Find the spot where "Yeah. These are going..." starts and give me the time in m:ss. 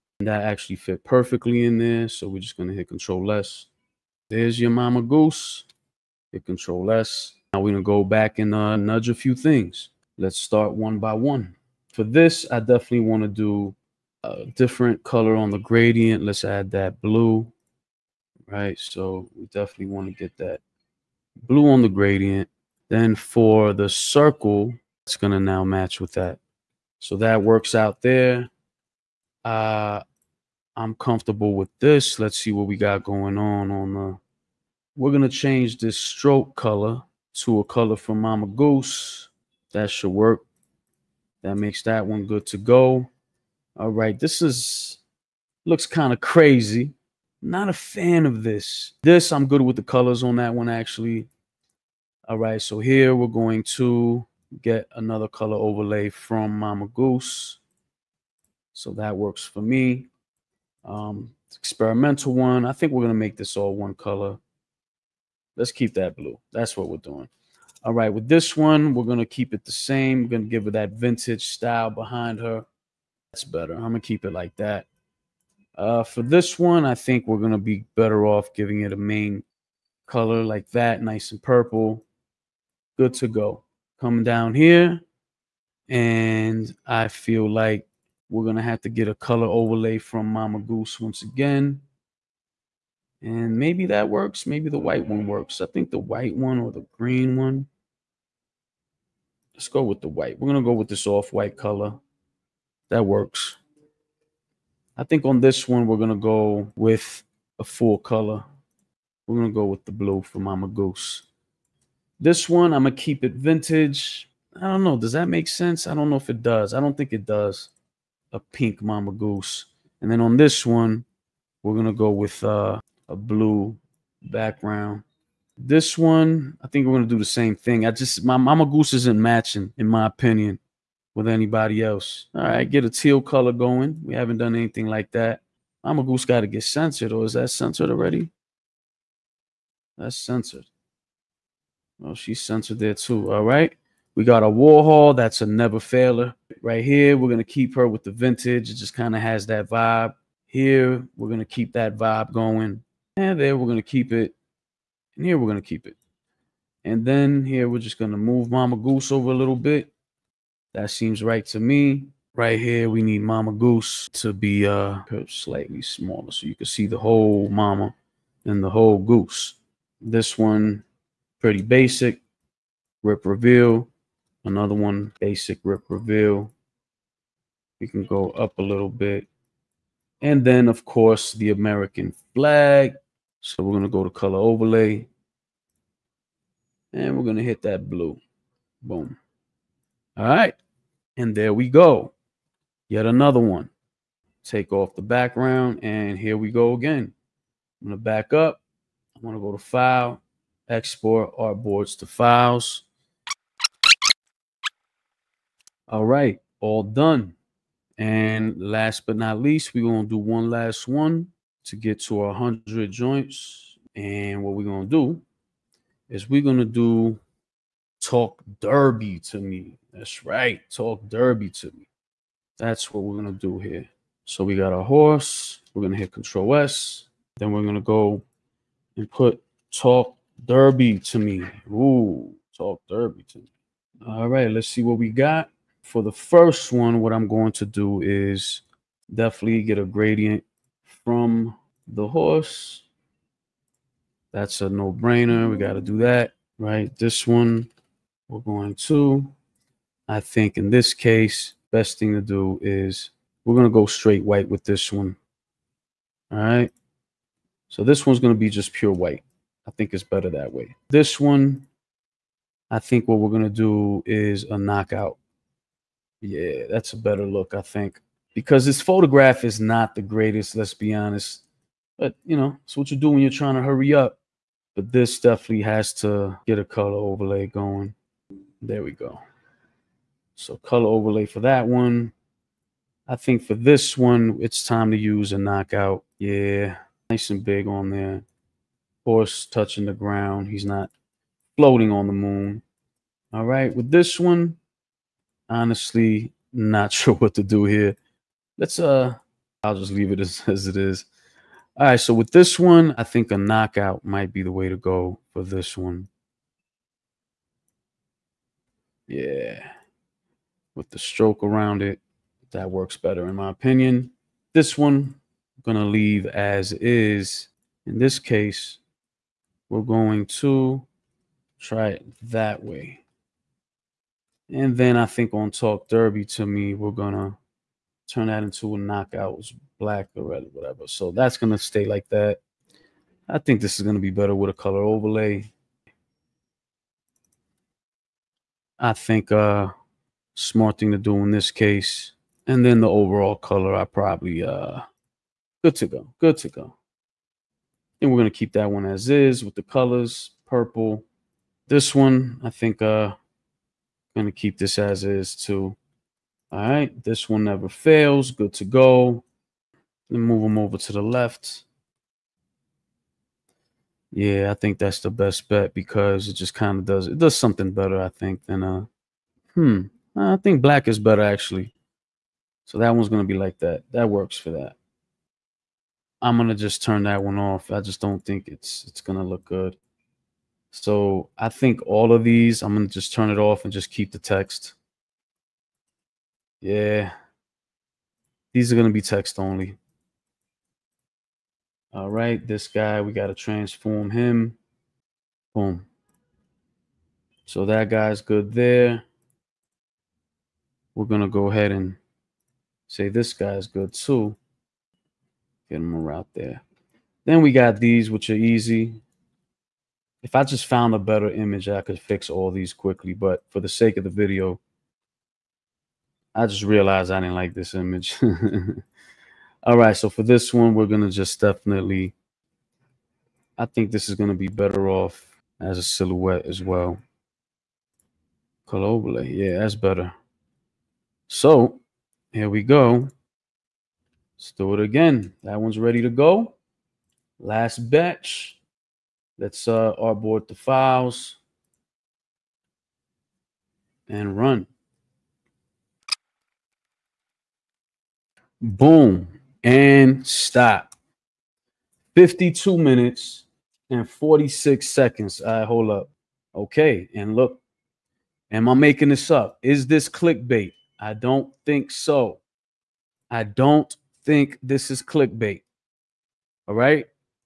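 6:26.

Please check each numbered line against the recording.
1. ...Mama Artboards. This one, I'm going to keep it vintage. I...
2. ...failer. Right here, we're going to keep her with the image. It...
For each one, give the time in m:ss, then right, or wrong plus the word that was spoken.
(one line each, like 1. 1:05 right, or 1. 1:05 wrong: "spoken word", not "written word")
1. 1:50 wrong: "Goose", not "Artboards"
2. 2:25 wrong: "vintage", not "image".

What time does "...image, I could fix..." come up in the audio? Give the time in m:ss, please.
6:51.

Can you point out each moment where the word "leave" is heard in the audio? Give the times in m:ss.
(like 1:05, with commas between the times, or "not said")
4:59, 5:15.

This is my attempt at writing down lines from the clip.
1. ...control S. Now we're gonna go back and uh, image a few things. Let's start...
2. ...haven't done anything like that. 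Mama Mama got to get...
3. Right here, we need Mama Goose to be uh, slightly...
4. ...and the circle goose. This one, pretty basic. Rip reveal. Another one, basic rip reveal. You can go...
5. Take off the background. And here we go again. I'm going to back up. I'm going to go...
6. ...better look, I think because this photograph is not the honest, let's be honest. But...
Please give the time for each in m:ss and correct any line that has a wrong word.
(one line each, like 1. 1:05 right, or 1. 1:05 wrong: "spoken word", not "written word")
1. 0:06 wrong: "nudge", not "image"
2. 2:14 wrong: "Goose", not "Mama"
3. 2:42 right
4. 2:48 wrong: "whole", not "circle"
5. 3:14 right
6. 4:26 wrong: "greatest", not "honest".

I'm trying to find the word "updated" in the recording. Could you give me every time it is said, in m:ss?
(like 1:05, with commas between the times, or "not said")
not said.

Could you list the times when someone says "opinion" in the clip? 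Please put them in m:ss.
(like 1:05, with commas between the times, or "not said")
2:10, 5:13.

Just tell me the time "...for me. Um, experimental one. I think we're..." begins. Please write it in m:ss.
0:59.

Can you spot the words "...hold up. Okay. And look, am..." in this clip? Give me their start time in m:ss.
7:35.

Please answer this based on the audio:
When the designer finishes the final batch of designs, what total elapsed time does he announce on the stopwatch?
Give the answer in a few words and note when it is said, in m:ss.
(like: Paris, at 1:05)
52 minutes and 46 seconds, at 7:32.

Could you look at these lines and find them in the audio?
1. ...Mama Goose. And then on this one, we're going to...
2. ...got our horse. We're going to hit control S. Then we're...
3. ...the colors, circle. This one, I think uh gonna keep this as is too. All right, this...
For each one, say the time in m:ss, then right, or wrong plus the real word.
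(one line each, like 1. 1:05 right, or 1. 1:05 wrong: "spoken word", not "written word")
1. 1:58 right
2. 3:44 right
3. 5:49 wrong: "purple", not "circle".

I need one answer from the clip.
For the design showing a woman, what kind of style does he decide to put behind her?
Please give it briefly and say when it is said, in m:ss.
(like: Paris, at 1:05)
vintage style, at 1:10.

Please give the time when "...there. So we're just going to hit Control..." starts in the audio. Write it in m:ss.
0:01.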